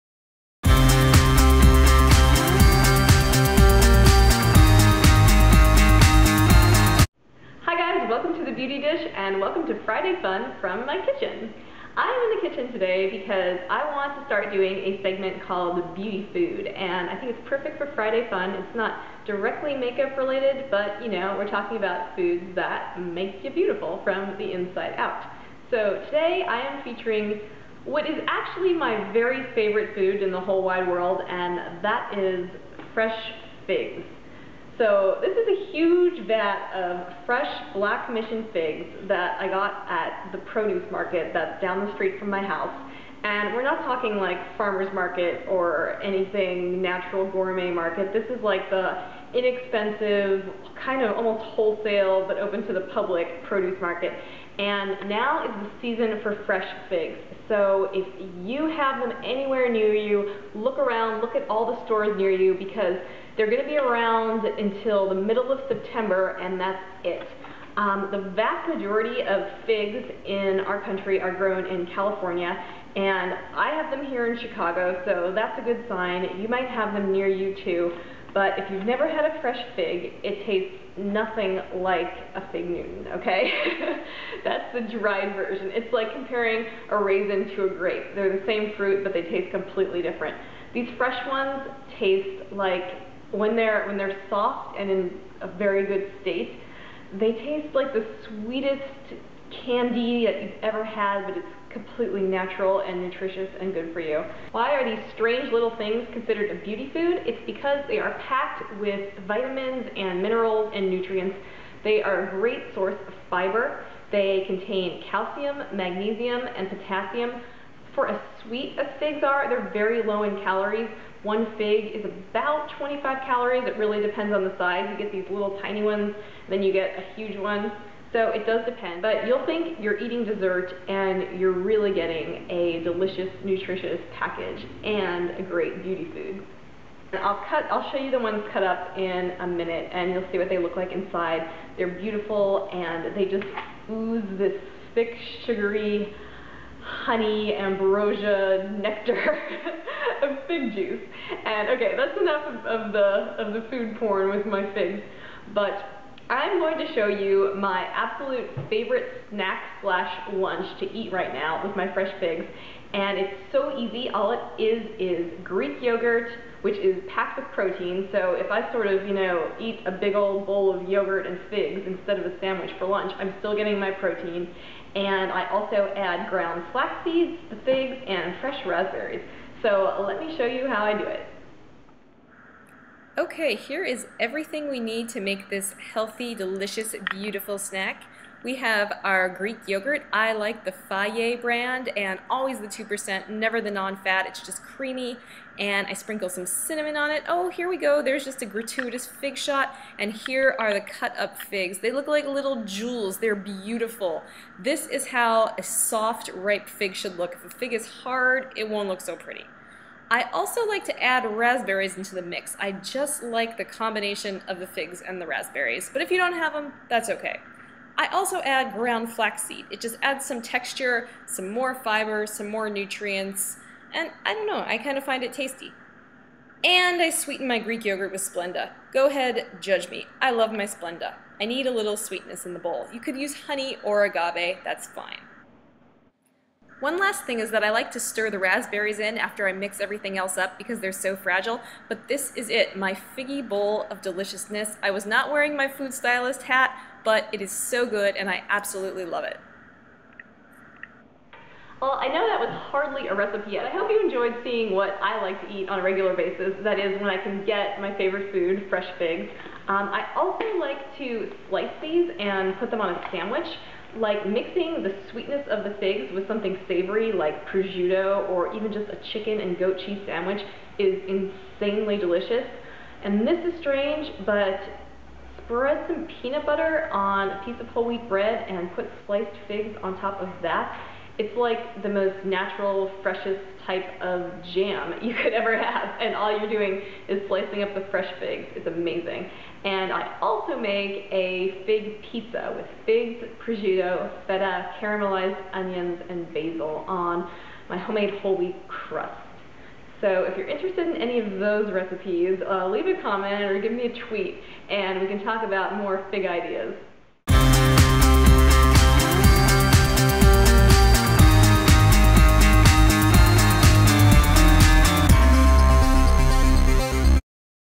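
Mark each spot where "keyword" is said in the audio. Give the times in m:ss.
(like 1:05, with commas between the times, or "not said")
not said.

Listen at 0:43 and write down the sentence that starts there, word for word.
And we're not talking like farmer's market or anything natural gourmet market.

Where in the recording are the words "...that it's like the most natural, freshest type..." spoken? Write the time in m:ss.
4:40.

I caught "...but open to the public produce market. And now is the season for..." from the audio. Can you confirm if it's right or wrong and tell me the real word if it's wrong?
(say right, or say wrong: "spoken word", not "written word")
right.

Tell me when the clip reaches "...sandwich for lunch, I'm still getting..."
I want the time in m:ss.
2:52.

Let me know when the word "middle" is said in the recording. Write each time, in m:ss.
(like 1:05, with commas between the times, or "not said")
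1:05.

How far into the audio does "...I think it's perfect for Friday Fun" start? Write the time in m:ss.
0:17.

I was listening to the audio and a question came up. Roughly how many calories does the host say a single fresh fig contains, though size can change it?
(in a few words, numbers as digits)
25.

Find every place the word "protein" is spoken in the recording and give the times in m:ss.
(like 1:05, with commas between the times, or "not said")
2:47, 2:53.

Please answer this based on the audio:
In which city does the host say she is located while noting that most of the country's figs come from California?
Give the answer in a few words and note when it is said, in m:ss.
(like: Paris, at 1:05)
Chicago, at 1:14.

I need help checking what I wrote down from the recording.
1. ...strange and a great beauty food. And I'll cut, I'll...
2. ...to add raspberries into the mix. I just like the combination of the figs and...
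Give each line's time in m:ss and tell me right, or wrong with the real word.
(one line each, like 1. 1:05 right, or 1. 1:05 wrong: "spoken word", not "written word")
1. 2:14 wrong: "package", not "strange"
2. 3:30 right.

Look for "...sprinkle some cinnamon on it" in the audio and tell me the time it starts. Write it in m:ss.
3:15.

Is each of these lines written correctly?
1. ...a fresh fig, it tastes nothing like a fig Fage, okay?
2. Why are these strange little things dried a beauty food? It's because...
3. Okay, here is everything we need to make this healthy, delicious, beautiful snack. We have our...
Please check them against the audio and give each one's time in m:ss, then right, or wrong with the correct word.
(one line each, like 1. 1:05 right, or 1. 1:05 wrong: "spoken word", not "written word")
1. 1:19 wrong: "Newton", not "Fage"
2. 1:44 wrong: "considered", not "dried"
3. 3:03 right.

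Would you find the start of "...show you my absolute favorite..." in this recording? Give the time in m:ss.
2:36.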